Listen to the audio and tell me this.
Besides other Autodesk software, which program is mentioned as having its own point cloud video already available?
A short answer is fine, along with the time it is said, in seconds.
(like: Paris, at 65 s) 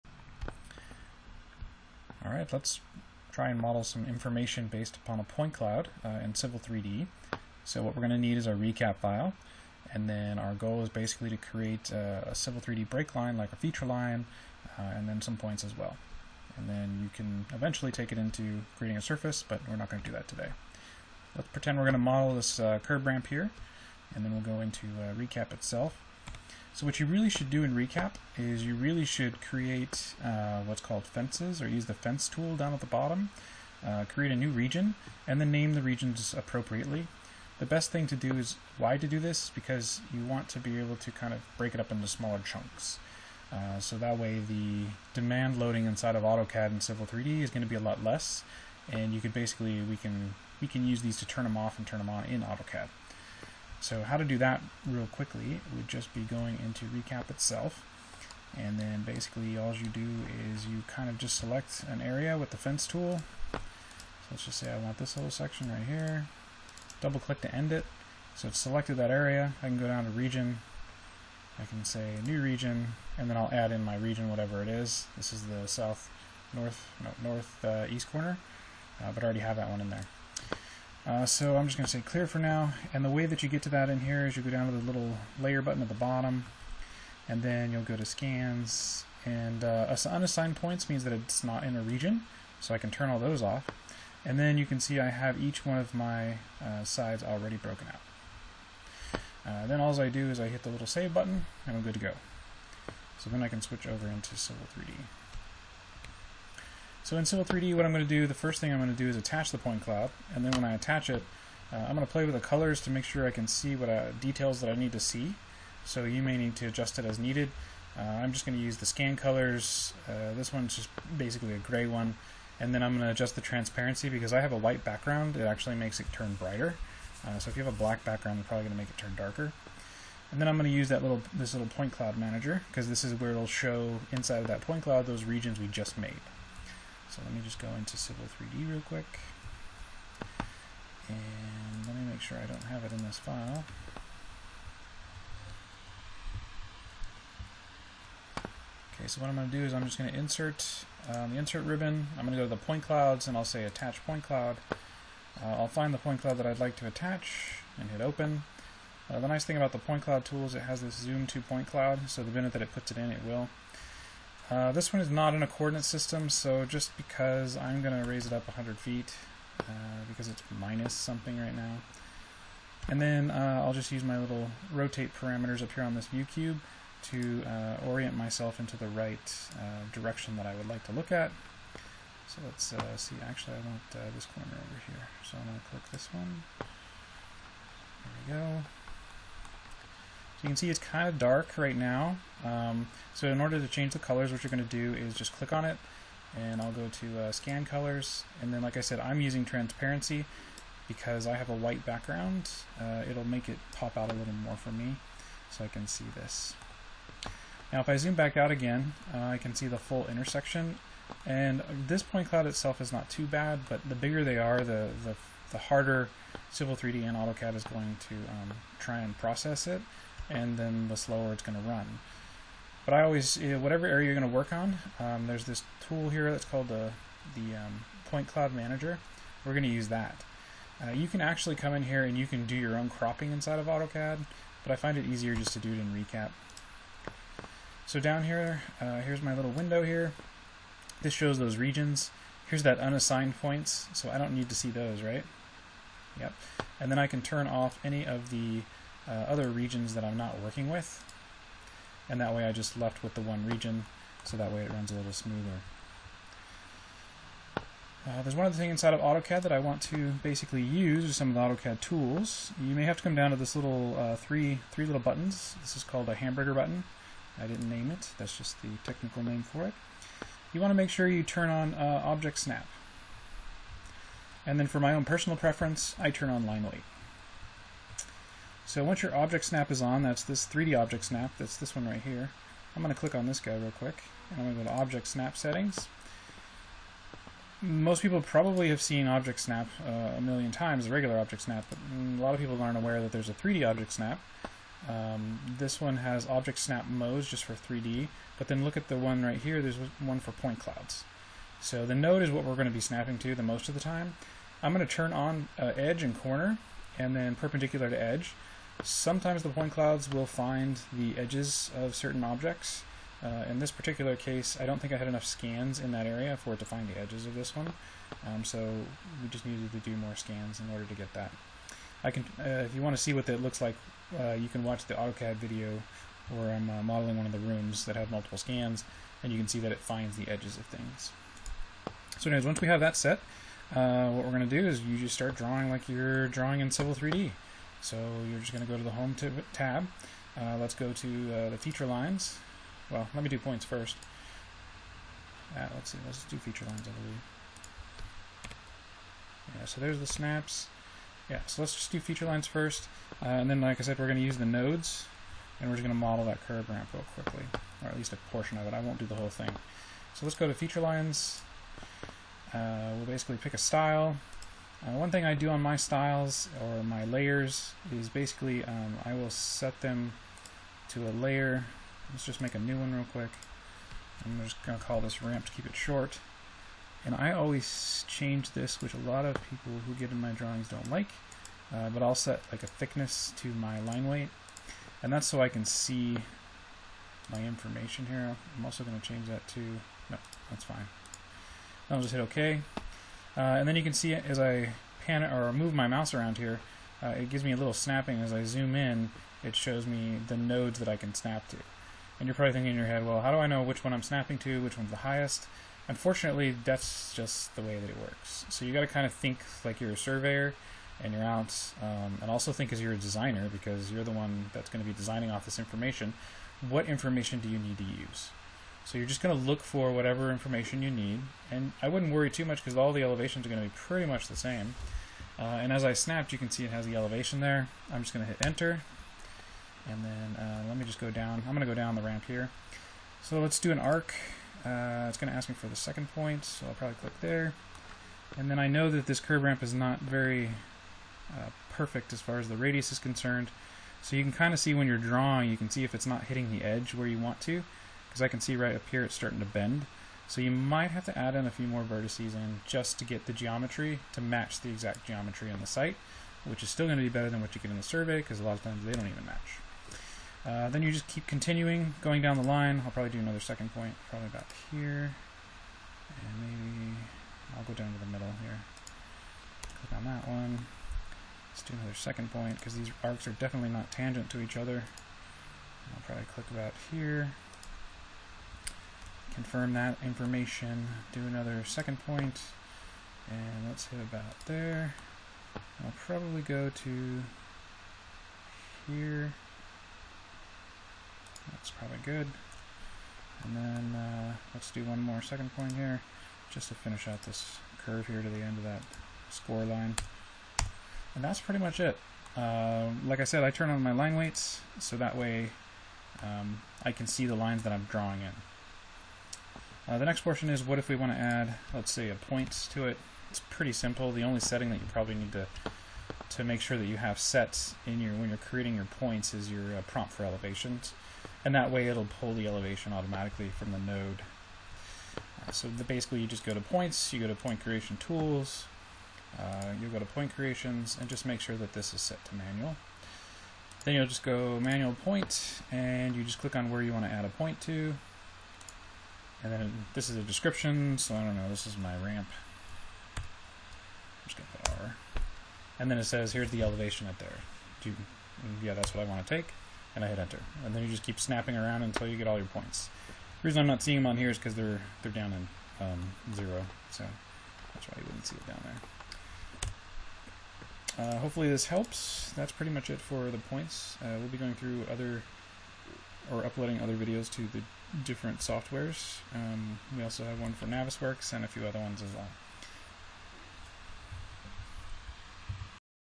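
Navisworks, at 570 s.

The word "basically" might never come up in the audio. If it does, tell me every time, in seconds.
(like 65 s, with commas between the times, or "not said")
10 s, 49 s, 59 s, 121 s, 260 s, 363 s, 368 s, 525 s.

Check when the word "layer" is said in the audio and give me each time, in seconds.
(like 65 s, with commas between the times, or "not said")
85 s, 367 s, 371 s.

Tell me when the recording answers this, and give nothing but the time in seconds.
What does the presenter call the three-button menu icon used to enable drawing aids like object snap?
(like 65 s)
266 s.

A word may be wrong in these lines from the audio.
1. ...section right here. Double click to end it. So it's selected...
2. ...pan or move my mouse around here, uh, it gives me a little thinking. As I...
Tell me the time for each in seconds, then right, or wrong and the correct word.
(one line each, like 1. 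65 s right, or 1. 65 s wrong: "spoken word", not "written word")
1. 65 s right
2. 395 s wrong: "snapping", not "thinking".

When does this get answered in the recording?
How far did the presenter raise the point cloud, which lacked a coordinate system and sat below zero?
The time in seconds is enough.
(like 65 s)
168 s.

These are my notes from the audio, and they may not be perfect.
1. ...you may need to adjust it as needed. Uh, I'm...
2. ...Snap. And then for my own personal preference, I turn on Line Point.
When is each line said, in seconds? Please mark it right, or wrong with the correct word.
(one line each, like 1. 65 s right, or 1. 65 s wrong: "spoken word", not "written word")
1. 116 s right
2. 272 s wrong: "Weight", not "Point".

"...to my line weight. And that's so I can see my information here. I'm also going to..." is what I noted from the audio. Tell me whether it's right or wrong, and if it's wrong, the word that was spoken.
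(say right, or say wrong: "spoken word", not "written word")
right.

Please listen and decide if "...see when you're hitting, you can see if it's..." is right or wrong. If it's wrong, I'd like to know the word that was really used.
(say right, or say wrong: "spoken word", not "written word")
wrong: "drawing", not "hitting".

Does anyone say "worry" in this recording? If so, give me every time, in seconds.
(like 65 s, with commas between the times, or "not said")
422 s.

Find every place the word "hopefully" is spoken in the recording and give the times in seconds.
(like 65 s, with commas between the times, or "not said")
561 s.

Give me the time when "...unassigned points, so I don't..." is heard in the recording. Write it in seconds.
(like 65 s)
242 s.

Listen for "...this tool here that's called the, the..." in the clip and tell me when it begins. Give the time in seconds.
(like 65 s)
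225 s.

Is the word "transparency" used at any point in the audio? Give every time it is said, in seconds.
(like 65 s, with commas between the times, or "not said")
123 s, 199 s.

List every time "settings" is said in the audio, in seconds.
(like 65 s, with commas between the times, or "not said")
285 s, 514 s.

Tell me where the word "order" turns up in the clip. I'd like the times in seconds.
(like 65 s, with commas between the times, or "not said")
193 s, 320 s.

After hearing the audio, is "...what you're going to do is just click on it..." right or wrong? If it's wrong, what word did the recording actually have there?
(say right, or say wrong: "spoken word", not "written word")
right.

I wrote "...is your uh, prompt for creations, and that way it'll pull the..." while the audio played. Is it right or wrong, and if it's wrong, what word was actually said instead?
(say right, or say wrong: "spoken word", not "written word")
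wrong: "elevations", not "creations".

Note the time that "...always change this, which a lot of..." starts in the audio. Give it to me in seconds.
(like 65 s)
377 s.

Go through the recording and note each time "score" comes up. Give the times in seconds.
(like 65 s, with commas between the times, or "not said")
499 s.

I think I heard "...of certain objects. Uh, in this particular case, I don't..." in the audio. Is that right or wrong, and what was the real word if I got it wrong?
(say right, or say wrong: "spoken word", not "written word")
right.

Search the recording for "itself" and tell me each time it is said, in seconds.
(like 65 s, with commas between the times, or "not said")
25 s, 57 s, 212 s.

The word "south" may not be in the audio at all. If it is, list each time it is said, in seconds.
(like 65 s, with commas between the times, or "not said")
75 s.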